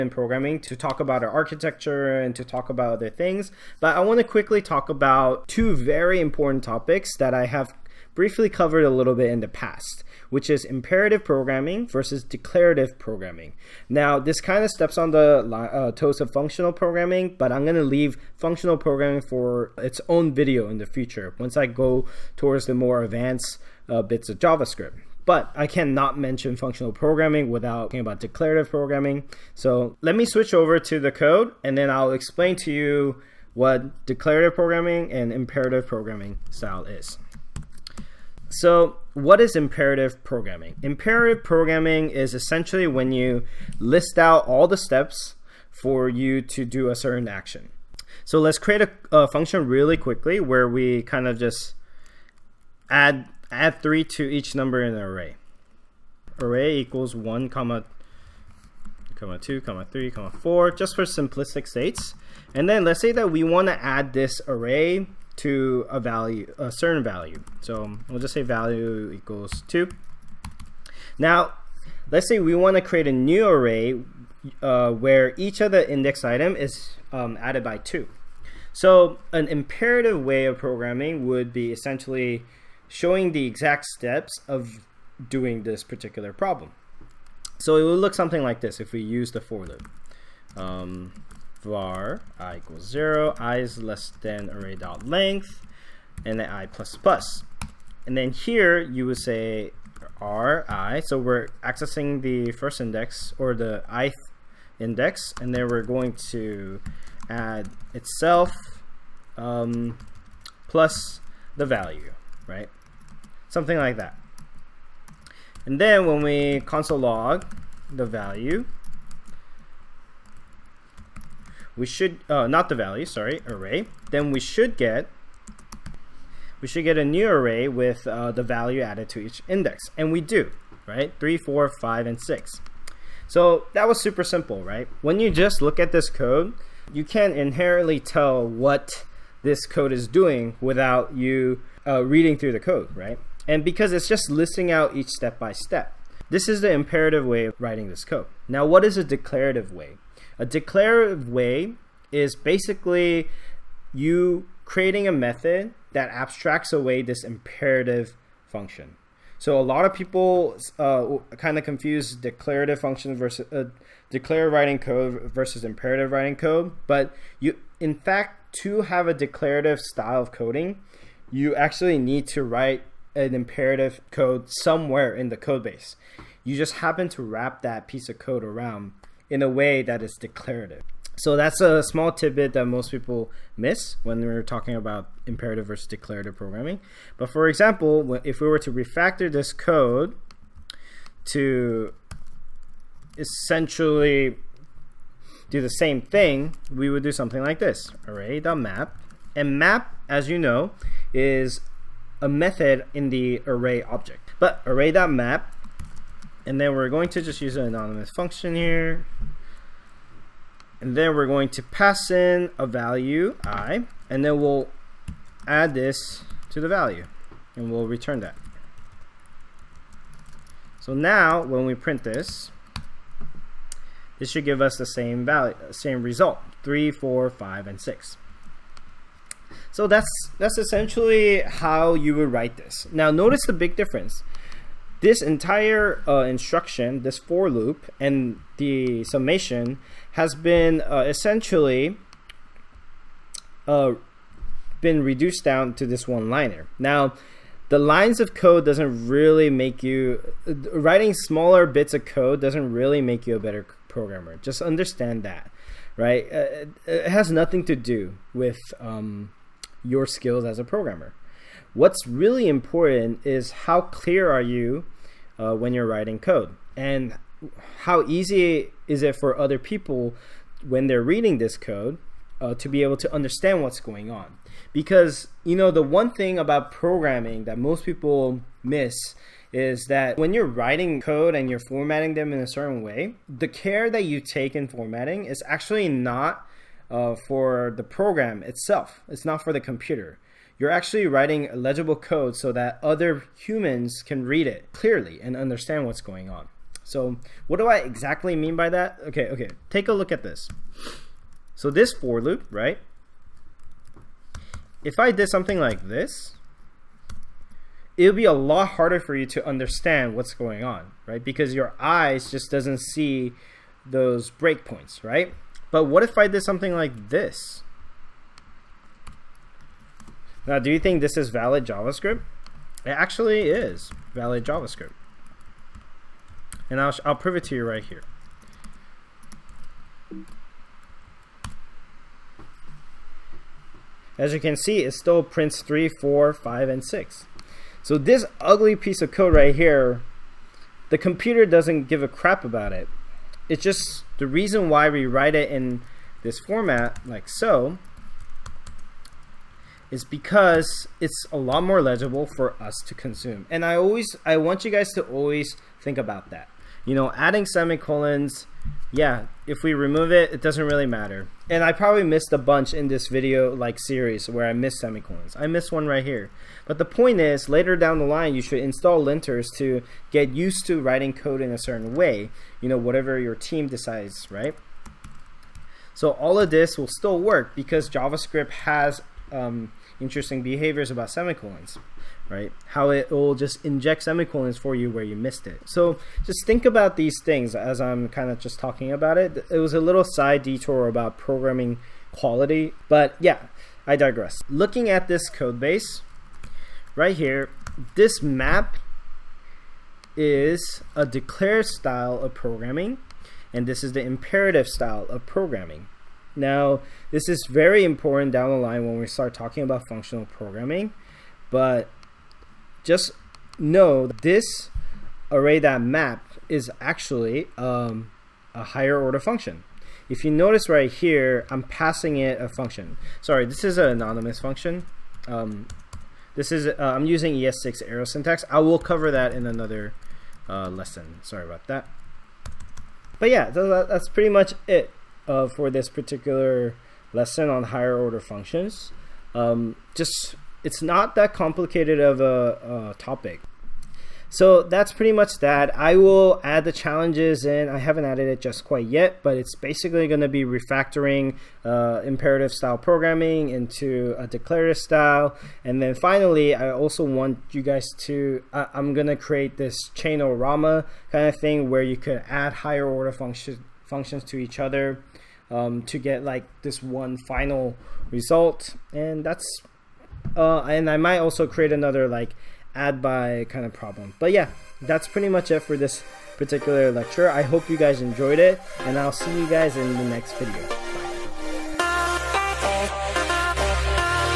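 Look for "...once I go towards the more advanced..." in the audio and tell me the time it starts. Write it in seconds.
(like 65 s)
21 s.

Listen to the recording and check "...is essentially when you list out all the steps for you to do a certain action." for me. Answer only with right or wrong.
right.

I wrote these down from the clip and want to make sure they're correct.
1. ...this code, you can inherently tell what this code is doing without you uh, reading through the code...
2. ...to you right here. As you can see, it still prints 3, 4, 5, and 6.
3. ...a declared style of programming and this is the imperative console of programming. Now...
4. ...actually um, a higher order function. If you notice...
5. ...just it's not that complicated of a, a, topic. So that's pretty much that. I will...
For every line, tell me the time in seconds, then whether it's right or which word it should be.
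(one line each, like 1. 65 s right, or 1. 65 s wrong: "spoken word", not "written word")
1. 135 s right
2. 327 s right
3. 400 s wrong: "style", not "console"
4. 416 s right
5. 439 s right.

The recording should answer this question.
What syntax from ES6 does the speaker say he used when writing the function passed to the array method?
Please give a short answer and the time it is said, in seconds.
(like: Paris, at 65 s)
arrow syntax, at 427 s.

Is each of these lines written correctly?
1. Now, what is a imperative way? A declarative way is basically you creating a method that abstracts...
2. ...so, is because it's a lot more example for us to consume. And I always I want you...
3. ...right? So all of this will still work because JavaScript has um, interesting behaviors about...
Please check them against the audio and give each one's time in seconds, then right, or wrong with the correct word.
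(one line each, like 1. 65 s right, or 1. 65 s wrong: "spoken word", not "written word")
1. 148 s wrong: "declarative", not "imperative"
2. 347 s wrong: "legible", not "example"
3. 374 s right.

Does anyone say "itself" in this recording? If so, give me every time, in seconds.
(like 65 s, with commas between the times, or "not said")
107 s, 288 s.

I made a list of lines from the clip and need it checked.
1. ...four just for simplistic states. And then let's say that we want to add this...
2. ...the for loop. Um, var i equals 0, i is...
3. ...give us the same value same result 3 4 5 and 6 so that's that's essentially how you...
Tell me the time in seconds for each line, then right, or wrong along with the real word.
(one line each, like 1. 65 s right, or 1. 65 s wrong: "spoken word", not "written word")
1. 60 s right
2. 89 s right
3. 224 s right.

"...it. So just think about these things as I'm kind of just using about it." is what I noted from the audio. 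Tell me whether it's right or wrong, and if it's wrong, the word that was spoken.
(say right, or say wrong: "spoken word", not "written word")
wrong: "talking", not "using".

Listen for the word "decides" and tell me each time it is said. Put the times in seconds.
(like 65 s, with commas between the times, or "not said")
373 s.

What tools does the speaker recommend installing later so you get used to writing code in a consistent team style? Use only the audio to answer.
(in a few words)
linters.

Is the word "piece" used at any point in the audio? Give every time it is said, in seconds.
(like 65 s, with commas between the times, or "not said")
177 s, 338 s.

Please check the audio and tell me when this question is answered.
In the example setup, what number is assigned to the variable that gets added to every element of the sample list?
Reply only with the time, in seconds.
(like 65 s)
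68 s.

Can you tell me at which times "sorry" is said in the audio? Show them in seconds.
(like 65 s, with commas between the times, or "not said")
123 s, 423 s, 431 s.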